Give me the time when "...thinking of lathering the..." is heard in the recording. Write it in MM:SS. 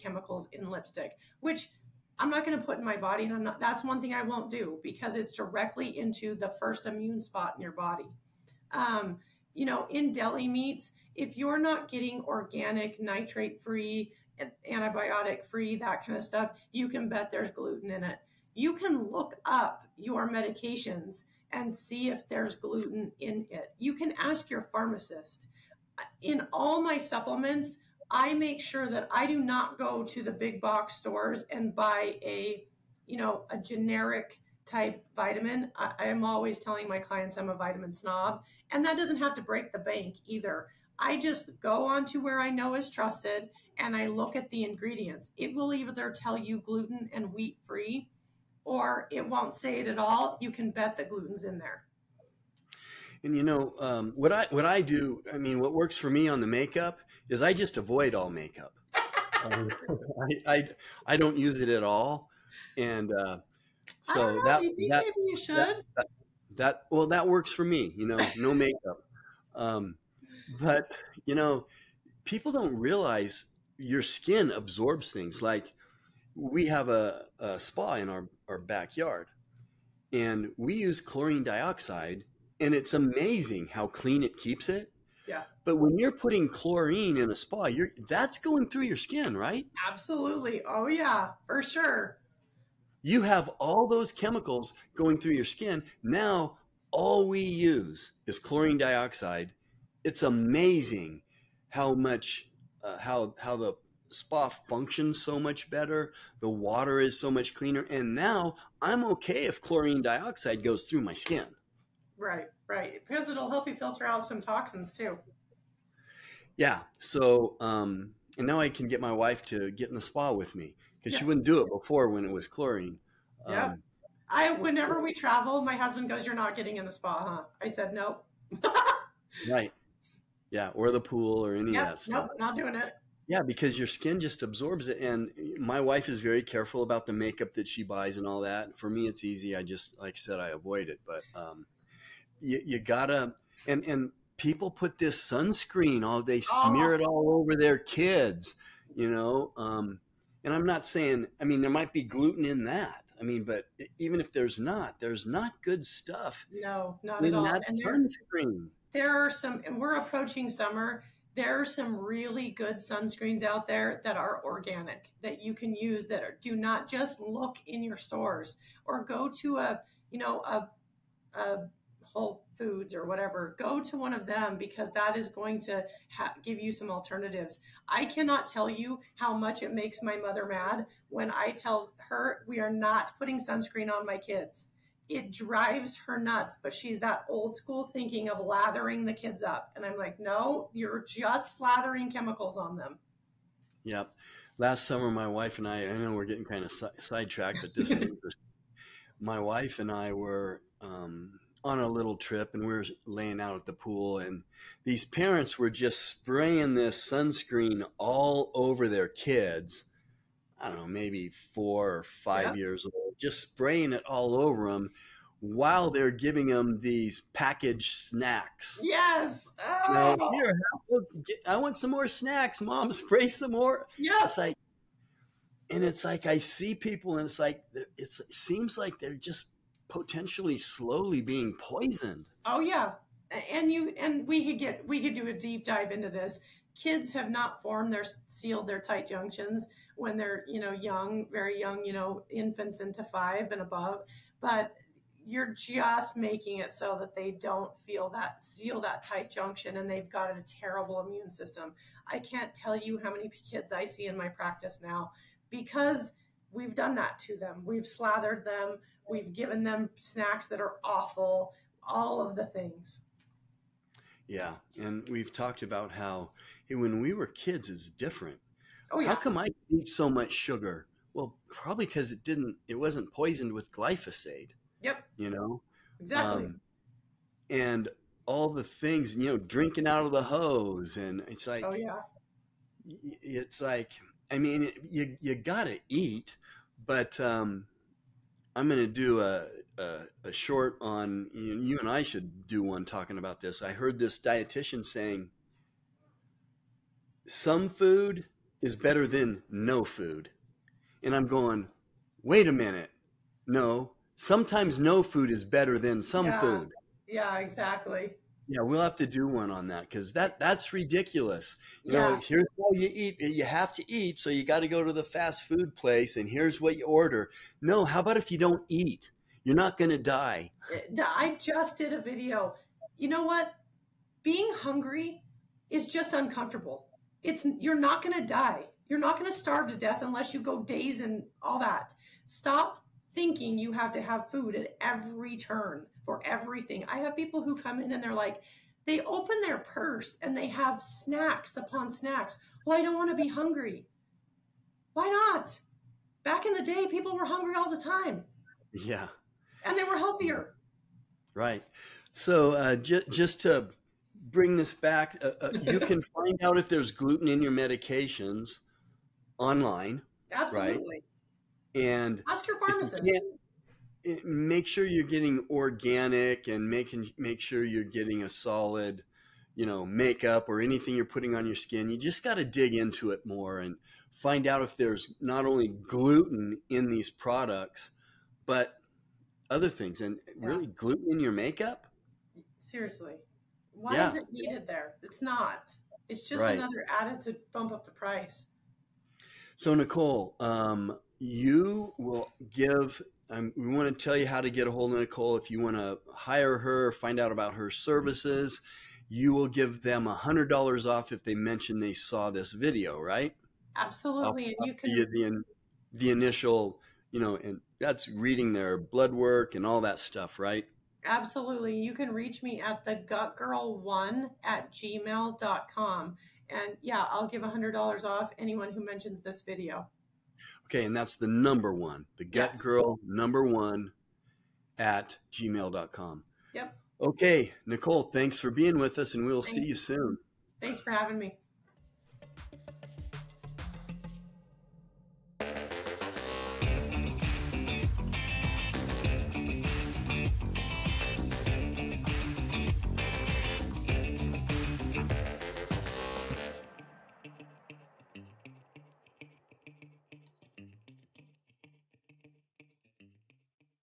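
03:07.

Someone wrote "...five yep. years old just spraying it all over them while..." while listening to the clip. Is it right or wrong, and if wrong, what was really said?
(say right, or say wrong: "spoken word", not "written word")
right.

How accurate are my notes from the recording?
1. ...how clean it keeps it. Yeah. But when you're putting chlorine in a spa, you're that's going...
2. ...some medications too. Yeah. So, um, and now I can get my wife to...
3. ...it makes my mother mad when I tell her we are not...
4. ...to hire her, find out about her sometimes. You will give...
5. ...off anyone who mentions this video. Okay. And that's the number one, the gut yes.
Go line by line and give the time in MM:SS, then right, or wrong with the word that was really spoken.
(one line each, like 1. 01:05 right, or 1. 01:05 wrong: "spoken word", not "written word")
1. 01:23 right
2. 01:54 wrong: "toxins", not "medications"
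3. 02:59 right
4. 06:35 wrong: "services", not "sometimes"
5. 06:58 right.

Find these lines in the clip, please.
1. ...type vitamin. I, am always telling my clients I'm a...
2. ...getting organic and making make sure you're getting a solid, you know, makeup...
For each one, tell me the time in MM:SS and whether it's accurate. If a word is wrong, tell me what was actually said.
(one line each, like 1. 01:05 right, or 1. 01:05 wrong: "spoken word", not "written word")
1. 00:34 right
2. 06:05 right.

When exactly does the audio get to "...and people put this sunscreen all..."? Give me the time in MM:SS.
02:23.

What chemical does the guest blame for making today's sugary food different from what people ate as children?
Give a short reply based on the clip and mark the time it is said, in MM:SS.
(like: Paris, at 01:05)
Glyphosate, at 04:33.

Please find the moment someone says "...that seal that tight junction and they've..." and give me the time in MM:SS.
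04:08.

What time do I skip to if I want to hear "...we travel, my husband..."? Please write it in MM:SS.
02:05.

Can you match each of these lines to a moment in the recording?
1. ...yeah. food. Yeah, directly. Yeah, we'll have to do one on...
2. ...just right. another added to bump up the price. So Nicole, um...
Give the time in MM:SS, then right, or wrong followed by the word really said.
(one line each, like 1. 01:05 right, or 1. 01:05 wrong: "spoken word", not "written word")
1. 05:06 wrong: "exactly", not "directly"
2. 06:26 right.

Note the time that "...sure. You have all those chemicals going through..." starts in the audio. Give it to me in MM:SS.
01:31.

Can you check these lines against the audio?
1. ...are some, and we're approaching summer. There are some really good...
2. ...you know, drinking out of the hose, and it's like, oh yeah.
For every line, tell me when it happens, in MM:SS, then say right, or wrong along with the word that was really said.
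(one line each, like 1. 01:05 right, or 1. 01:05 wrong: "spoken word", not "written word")
1. 02:39 right
2. 04:39 right.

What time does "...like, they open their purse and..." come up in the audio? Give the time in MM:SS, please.
05:38.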